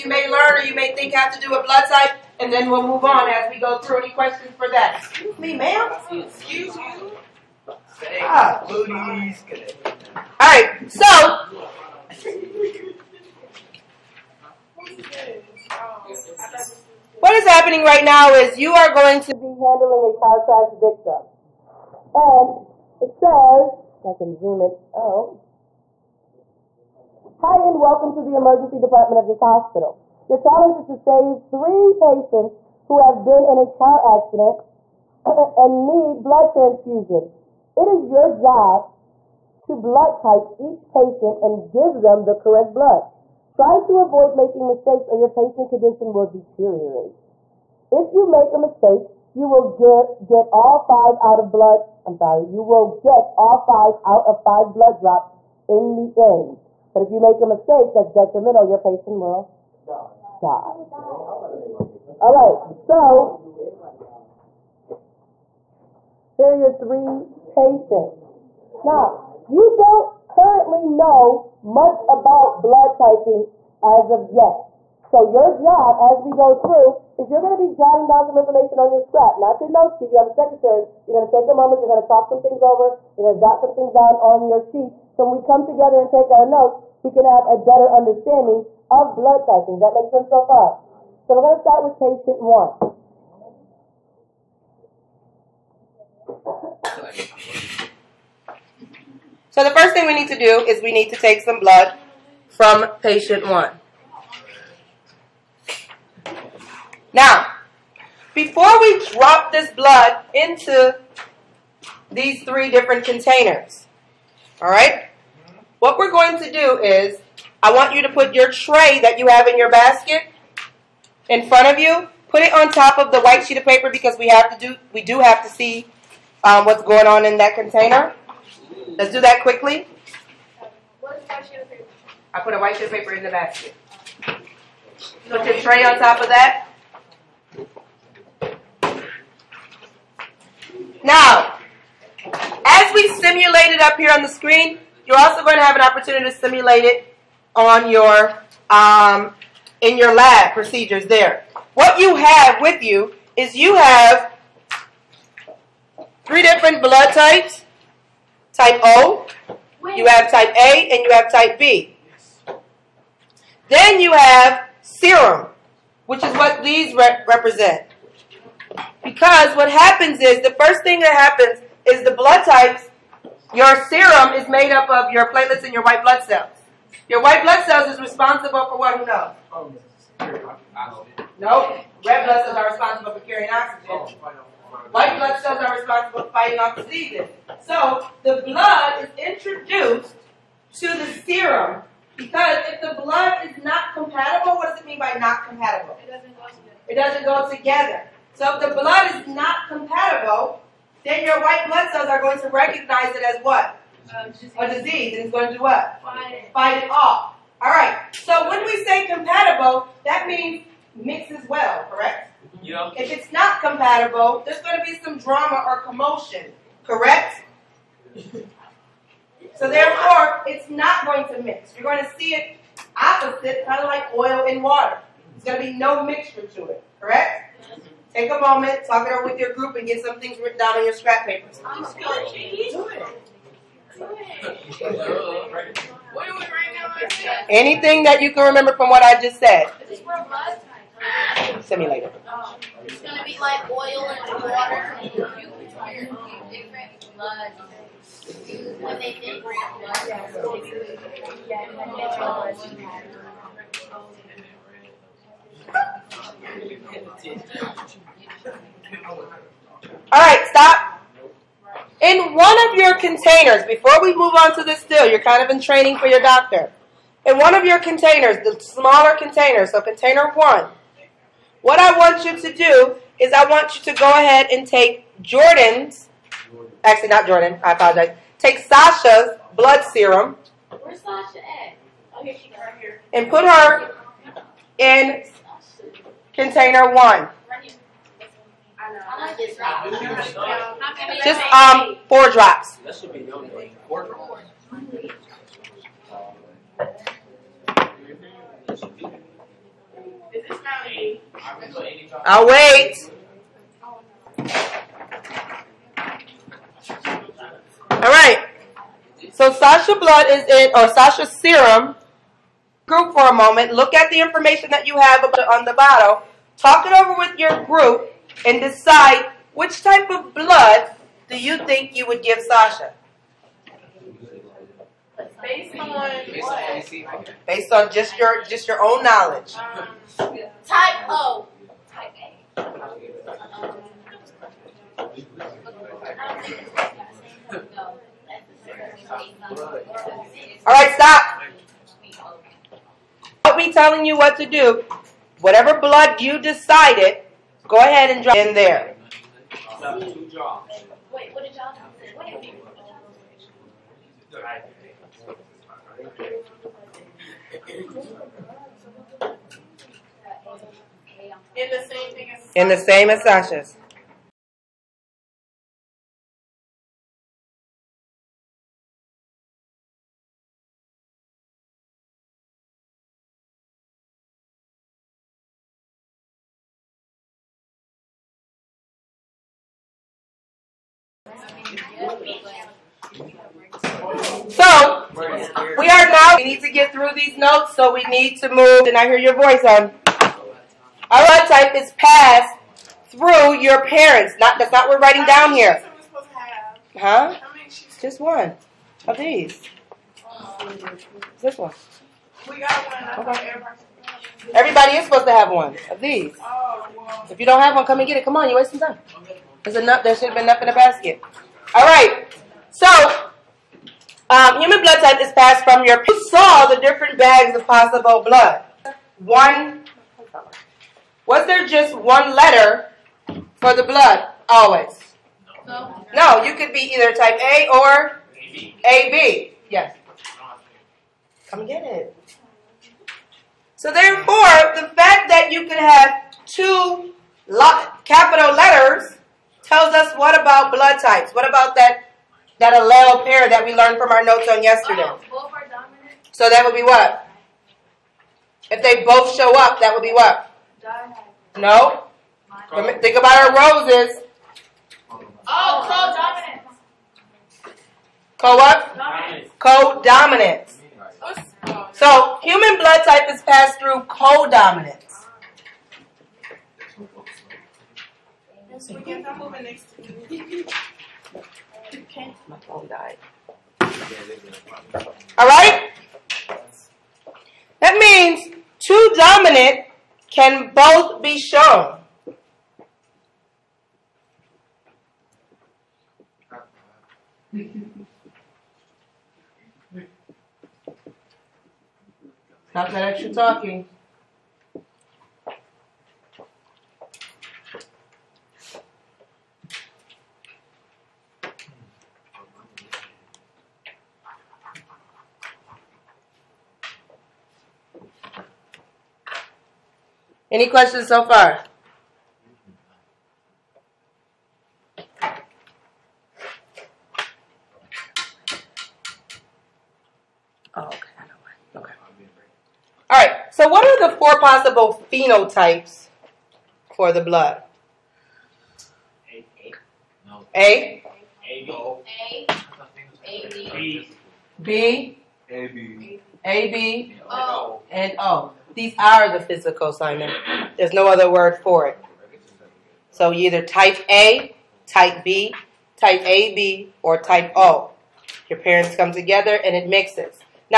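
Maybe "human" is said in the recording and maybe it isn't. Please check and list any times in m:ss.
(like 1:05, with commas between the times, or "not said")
6:54, 7:42.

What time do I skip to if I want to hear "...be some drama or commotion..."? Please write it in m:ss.
3:34.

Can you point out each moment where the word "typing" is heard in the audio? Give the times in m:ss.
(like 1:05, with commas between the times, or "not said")
1:12, 1:29.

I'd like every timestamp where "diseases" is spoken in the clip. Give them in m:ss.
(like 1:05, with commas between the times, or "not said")
3:06, 3:24.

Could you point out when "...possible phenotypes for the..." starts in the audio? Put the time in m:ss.
8:44.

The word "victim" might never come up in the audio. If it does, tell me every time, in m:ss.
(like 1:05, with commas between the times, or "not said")
0:20.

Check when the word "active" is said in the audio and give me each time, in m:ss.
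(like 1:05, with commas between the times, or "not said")
not said.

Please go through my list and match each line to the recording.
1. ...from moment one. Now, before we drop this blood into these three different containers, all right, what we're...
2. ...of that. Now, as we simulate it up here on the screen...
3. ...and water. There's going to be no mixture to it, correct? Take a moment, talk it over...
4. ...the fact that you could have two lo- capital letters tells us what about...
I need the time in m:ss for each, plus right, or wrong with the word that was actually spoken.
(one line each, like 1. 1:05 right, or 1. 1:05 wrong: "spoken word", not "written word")
1. 1:42 wrong: "patient", not "moment"
2. 2:16 right
3. 3:44 right
4. 7:14 right.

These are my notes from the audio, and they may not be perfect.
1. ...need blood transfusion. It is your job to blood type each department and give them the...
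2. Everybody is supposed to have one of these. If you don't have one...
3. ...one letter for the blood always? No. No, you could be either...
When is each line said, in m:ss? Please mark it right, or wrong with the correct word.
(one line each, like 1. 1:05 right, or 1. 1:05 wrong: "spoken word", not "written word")
1. 0:35 wrong: "patient", not "department"
2. 6:44 right
3. 7:01 right.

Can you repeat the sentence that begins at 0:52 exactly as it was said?
I'm sorry, you will get all five out of five blood drops in the end.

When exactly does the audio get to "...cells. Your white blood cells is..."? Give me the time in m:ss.
2:56.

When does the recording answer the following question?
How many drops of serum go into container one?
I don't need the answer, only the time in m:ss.
4:52.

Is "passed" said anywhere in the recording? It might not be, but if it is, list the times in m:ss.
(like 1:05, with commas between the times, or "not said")
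6:31, 6:55, 7:43.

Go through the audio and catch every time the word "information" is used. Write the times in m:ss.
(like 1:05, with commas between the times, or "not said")
1:18, 5:14.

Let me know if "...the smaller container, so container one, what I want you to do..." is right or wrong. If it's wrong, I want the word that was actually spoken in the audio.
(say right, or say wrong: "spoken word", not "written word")
right.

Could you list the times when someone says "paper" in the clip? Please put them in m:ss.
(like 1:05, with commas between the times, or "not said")
2:03, 2:12, 3:51.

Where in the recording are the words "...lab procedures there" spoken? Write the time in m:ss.
2:30.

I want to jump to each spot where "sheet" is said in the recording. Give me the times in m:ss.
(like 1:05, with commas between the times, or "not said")
1:19, 1:24, 2:03, 2:12.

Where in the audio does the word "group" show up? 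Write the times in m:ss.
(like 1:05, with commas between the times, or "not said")
3:49, 5:12, 5:17.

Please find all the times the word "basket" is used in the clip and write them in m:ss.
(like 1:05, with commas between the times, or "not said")
1:59, 2:13, 6:50.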